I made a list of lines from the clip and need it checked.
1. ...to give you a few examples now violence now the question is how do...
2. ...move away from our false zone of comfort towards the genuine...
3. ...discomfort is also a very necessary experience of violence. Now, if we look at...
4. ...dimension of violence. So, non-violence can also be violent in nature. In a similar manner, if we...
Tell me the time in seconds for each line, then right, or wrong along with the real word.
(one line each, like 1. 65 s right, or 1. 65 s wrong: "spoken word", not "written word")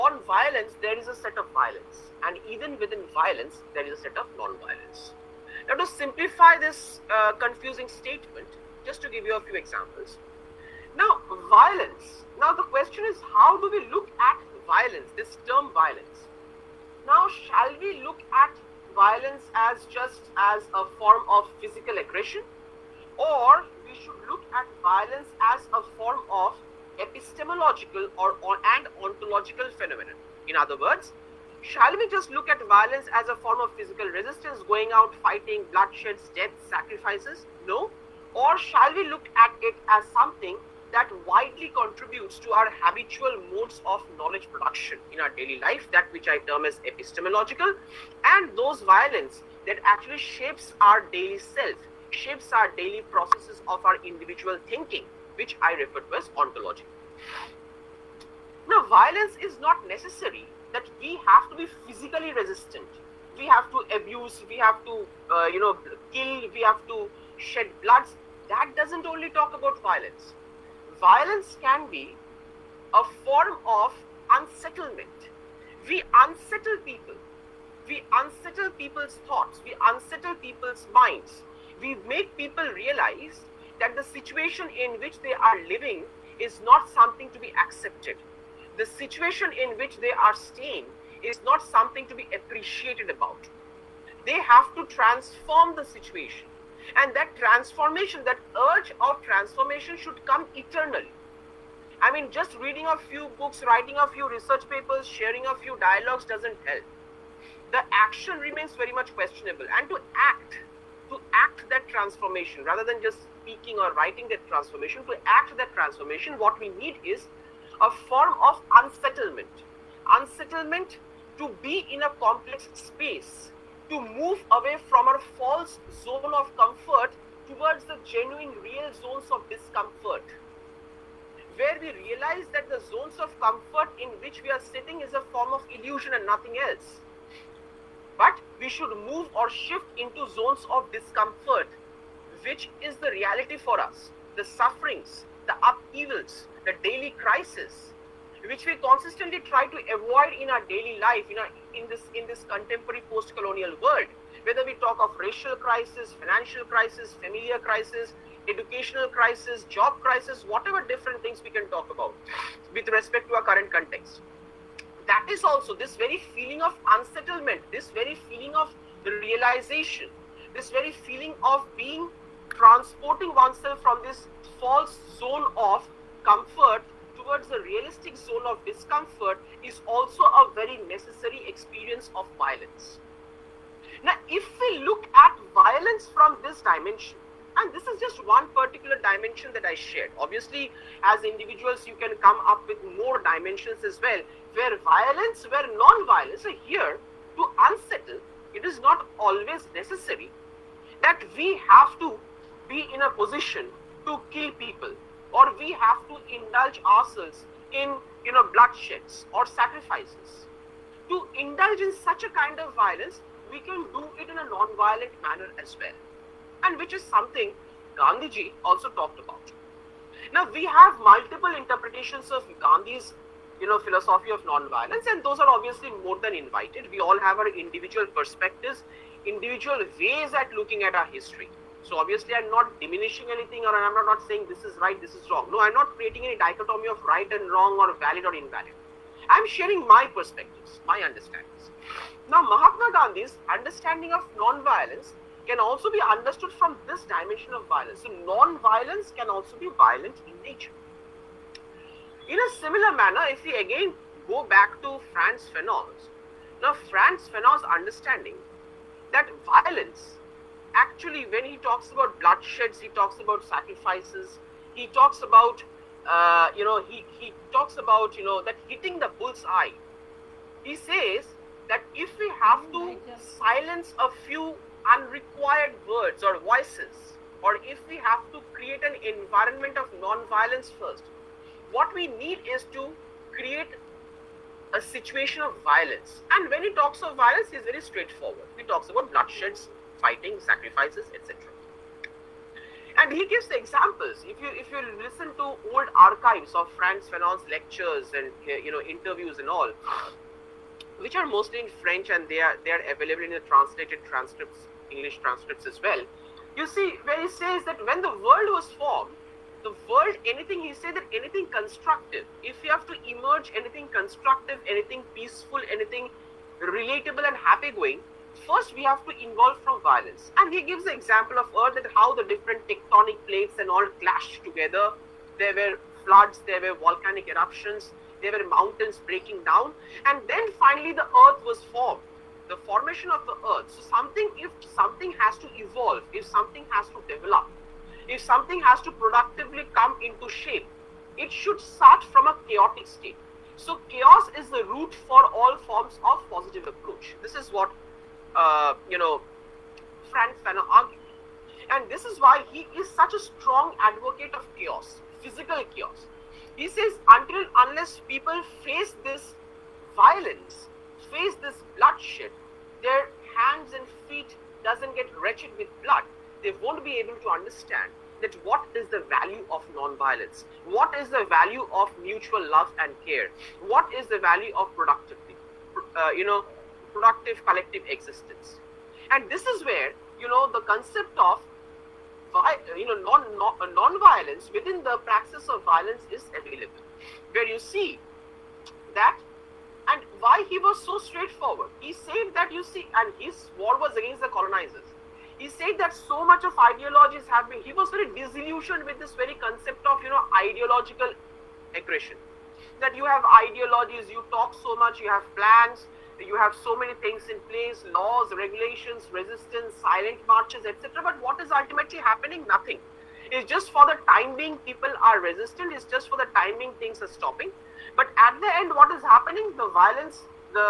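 1. 9 s right
2. 124 s right
3. 178 s right
4. 247 s right.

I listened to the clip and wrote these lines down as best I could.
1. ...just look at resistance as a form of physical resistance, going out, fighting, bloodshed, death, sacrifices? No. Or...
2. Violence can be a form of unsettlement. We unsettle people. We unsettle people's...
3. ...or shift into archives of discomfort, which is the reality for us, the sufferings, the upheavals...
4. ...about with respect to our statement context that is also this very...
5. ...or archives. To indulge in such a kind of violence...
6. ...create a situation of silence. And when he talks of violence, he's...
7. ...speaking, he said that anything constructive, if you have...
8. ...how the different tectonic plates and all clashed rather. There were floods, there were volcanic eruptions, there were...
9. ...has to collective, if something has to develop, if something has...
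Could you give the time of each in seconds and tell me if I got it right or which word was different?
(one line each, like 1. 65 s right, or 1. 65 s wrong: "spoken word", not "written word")
1. 32 s wrong: "violence", not "resistance"
2. 70 s right
3. 139 s wrong: "zones", not "archives"
4. 161 s wrong: "current", not "statement"
5. 209 s wrong: "sacrifices", not "archives"
6. 283 s wrong: "violence", not "silence"
7. 310 s wrong: "anything", not "speaking"
8. 321 s wrong: "together", not "rather"
9. 335 s wrong: "evolve", not "collective".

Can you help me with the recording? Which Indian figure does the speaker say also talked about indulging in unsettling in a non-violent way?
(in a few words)
Gandhiji.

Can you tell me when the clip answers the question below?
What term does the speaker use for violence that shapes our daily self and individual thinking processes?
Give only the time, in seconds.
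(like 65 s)
56 s.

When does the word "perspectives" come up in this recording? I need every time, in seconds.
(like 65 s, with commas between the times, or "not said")
228 s, 240 s.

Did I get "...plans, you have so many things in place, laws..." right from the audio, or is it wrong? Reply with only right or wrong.
right.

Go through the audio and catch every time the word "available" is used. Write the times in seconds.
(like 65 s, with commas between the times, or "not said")
302 s, 386 s.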